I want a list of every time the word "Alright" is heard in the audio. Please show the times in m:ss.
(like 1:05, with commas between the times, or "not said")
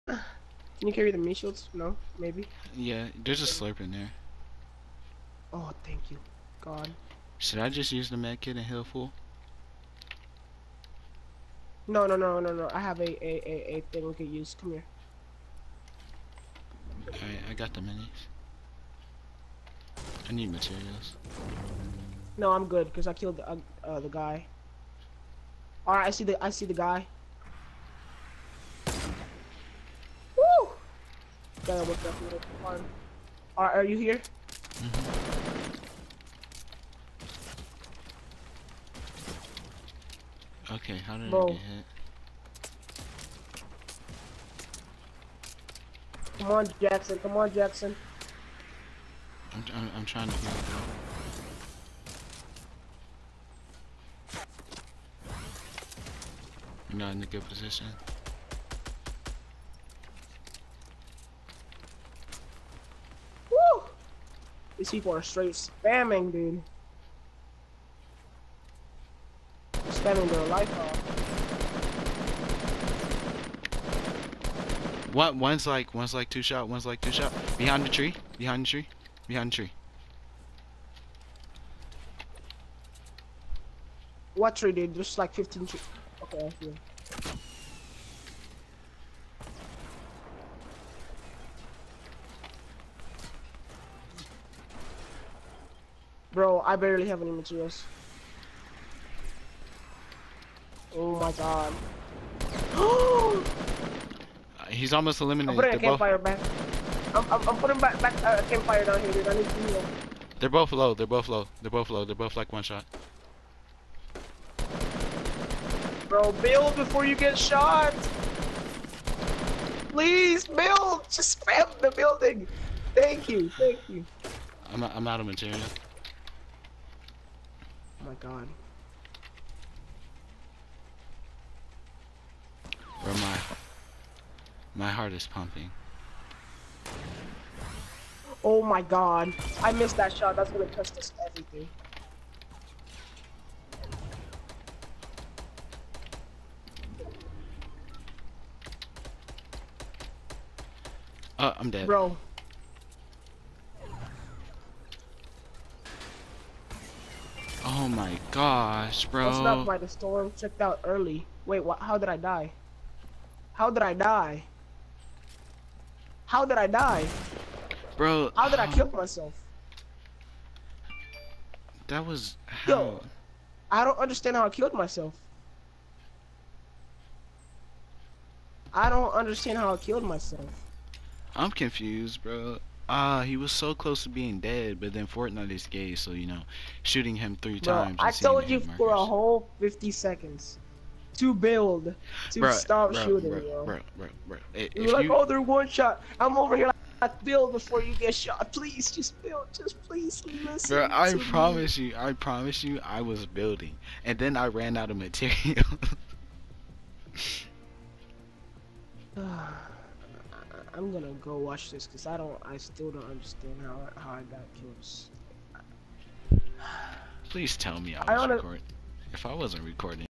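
0:17, 0:25.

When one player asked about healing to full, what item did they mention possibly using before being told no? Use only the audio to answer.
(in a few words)
Medkit.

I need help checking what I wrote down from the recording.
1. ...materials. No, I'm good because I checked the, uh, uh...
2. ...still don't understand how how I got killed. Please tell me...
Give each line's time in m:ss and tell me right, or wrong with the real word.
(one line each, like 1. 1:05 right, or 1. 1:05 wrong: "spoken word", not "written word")
1. 0:20 wrong: "killed", not "checked"
2. 3:32 right.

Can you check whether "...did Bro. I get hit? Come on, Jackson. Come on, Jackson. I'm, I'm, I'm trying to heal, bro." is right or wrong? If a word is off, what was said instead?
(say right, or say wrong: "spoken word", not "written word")
right.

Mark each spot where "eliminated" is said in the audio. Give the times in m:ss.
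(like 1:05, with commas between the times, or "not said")
1:45.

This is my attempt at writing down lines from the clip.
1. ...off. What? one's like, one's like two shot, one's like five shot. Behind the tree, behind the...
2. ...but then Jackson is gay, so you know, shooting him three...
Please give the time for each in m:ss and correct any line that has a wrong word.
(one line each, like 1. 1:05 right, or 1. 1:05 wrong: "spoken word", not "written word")
1. 1:10 wrong: "two", not "five"
2. 3:04 wrong: "Fortnite", not "Jackson".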